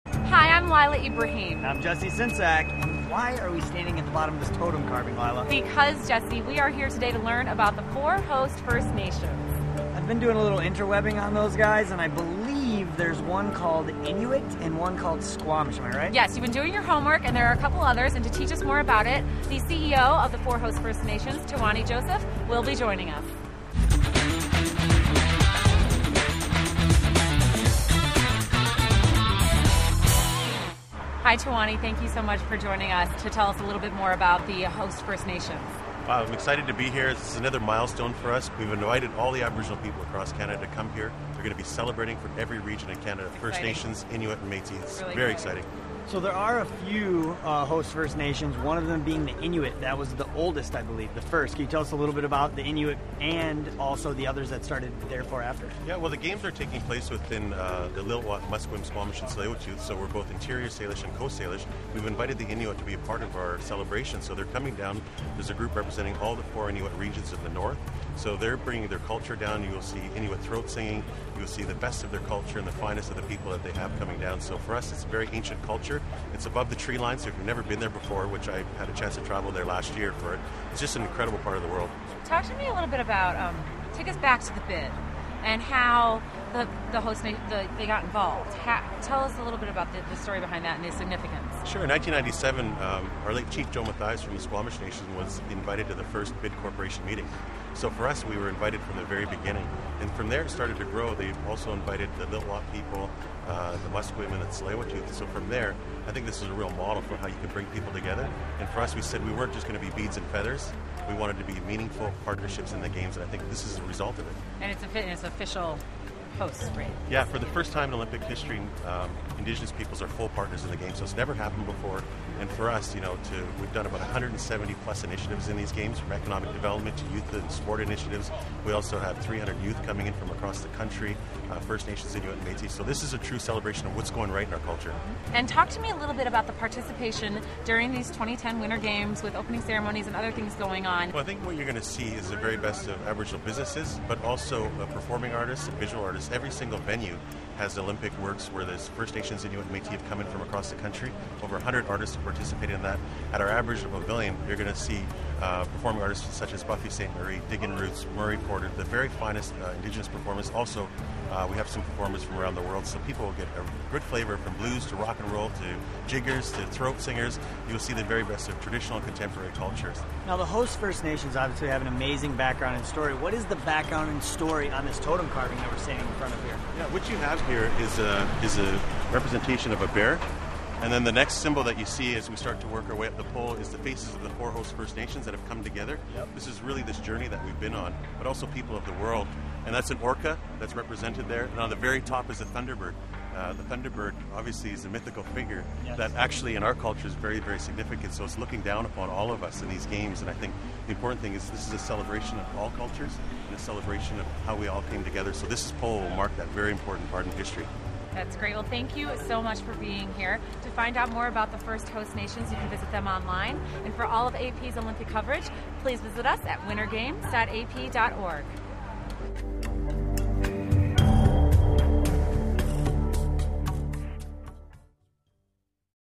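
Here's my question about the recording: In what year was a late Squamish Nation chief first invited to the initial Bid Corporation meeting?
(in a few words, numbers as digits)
1997.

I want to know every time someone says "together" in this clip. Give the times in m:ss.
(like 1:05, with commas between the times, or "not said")
1:47, 3:05, 3:25.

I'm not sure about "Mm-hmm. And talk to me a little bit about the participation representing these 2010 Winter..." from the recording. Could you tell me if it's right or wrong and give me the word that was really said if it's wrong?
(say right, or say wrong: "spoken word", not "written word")
wrong: "during", not "representing".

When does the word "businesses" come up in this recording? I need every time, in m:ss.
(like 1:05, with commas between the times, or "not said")
2:23.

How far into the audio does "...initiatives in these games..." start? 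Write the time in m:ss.
2:05.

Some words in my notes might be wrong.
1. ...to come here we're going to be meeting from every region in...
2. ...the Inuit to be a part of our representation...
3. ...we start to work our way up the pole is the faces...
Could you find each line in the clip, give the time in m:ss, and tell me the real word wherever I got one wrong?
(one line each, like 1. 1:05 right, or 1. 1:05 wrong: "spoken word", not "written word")
1. 0:40 wrong: "celebrating", not "meeting"
2. 1:02 wrong: "celebration", not "representation"
3. 3:02 right.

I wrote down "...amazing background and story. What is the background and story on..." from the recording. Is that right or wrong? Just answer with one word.
right.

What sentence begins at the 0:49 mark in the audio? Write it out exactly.
That was the oldest, I believe, the first.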